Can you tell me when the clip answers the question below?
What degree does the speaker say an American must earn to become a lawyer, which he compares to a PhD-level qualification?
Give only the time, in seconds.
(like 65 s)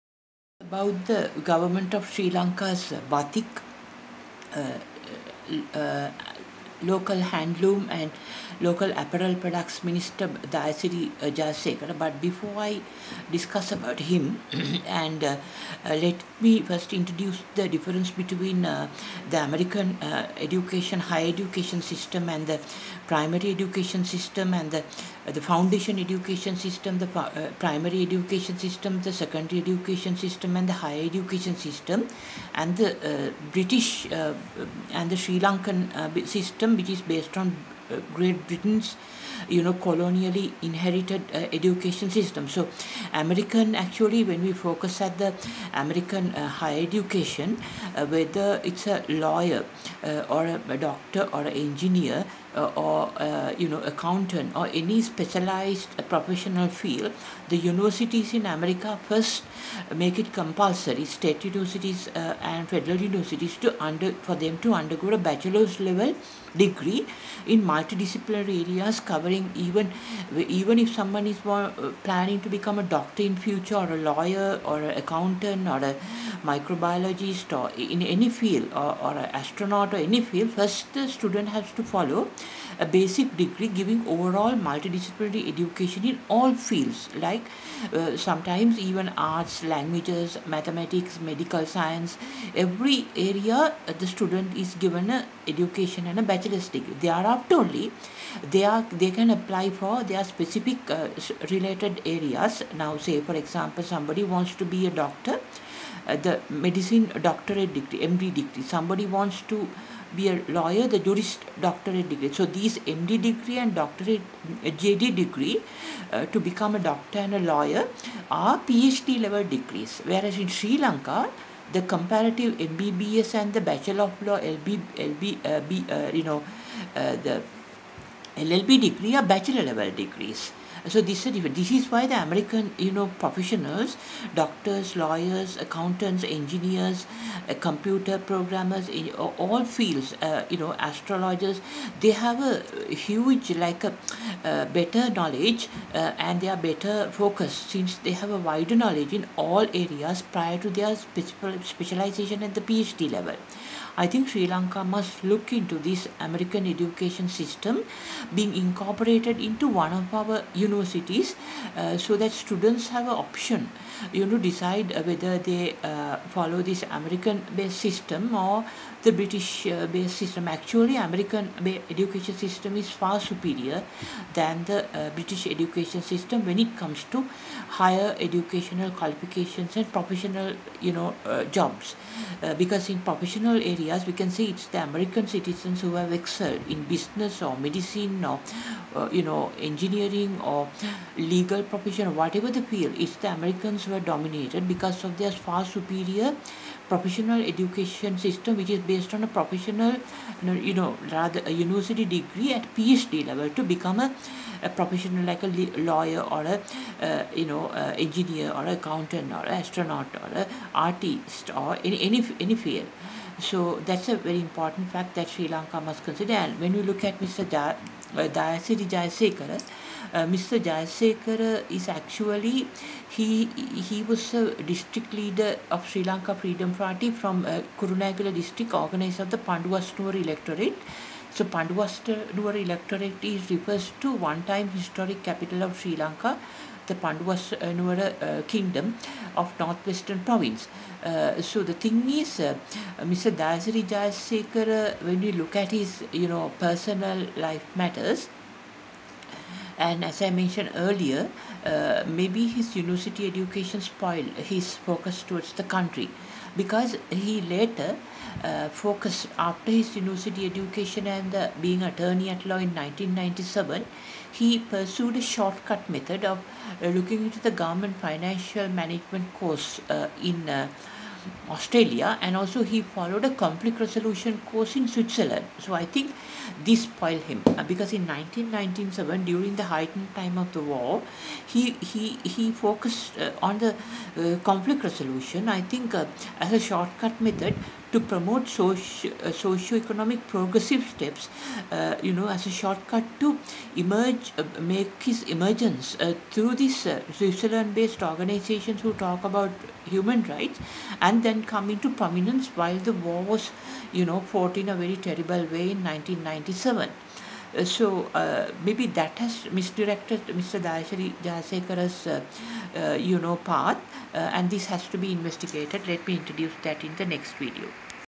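110 s.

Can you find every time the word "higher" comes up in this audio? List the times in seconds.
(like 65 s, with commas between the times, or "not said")
20 s, 30 s, 46 s, 177 s.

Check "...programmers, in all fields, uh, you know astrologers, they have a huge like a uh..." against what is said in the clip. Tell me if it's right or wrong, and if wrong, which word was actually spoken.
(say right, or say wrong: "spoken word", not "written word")
right.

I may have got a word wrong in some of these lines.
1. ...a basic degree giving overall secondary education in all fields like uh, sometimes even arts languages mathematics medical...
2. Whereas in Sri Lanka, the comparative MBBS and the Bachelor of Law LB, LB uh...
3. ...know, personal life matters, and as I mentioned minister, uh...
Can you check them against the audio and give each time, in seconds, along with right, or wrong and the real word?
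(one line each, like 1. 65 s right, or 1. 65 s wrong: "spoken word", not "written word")
1. 82 s wrong: "multidisciplinary", not "secondary"
2. 120 s right
3. 246 s wrong: "earlier", not "minister".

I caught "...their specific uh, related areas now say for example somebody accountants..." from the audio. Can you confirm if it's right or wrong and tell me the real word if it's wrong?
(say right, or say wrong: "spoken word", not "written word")
wrong: "wants", not "accountants".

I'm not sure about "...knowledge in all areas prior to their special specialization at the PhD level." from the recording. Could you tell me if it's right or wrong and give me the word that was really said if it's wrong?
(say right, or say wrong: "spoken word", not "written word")
right.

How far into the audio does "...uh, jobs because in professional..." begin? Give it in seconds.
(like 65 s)
181 s.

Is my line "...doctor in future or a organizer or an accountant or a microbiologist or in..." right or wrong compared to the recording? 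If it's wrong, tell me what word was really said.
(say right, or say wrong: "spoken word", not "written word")
wrong: "lawyer", not "organizer".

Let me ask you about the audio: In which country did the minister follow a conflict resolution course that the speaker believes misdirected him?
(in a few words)
Switzerland.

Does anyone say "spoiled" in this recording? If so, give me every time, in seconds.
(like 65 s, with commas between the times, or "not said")
253 s, 276 s.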